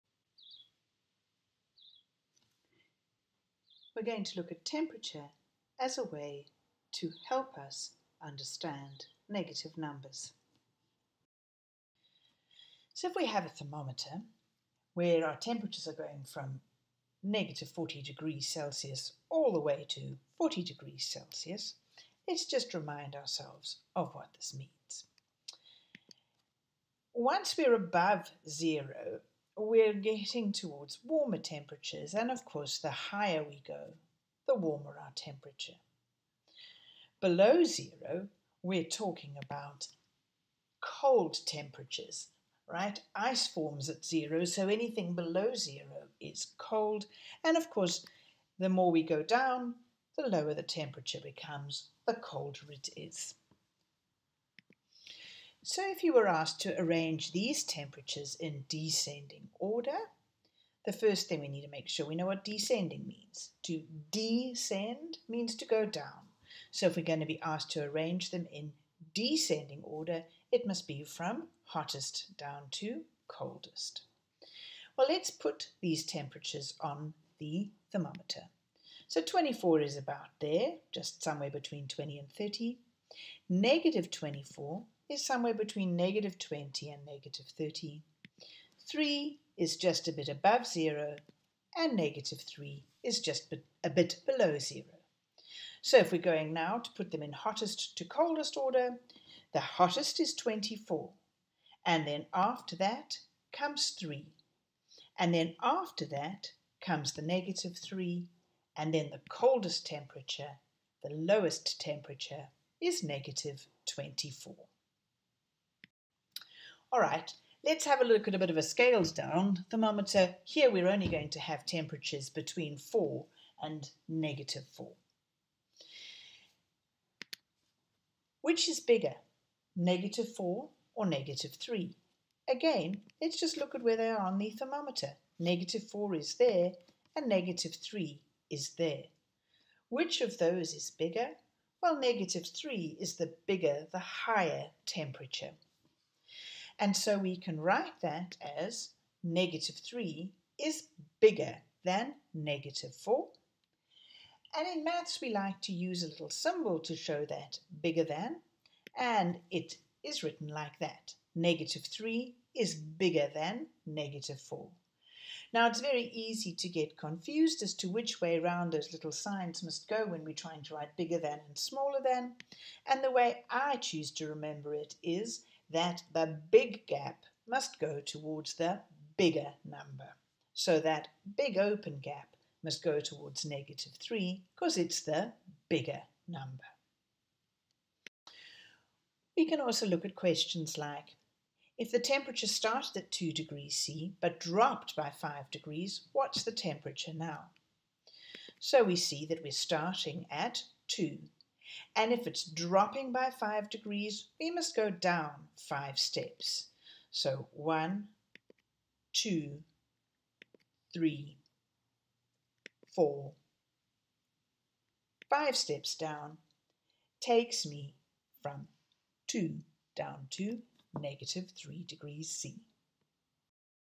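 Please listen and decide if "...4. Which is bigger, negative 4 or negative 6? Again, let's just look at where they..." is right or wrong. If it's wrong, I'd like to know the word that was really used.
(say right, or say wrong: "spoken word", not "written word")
wrong: "3", not "6".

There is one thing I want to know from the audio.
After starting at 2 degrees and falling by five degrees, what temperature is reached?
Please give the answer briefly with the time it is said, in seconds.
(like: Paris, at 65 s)
-3 degrees C, at 220 s.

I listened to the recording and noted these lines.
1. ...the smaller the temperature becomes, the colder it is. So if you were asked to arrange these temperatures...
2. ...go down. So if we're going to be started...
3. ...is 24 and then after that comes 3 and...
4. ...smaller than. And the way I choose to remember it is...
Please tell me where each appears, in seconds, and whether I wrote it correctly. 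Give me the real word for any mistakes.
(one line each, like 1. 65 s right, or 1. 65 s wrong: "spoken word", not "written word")
1. 50 s wrong: "lower", not "smaller"
2. 65 s wrong: "asked", not "started"
3. 100 s right
4. 171 s right.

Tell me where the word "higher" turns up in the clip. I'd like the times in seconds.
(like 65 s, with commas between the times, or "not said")
32 s, 144 s.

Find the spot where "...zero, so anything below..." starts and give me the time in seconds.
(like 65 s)
44 s.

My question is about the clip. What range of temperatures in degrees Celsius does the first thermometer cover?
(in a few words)
-40 to 40.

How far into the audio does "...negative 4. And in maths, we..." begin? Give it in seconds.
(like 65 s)
152 s.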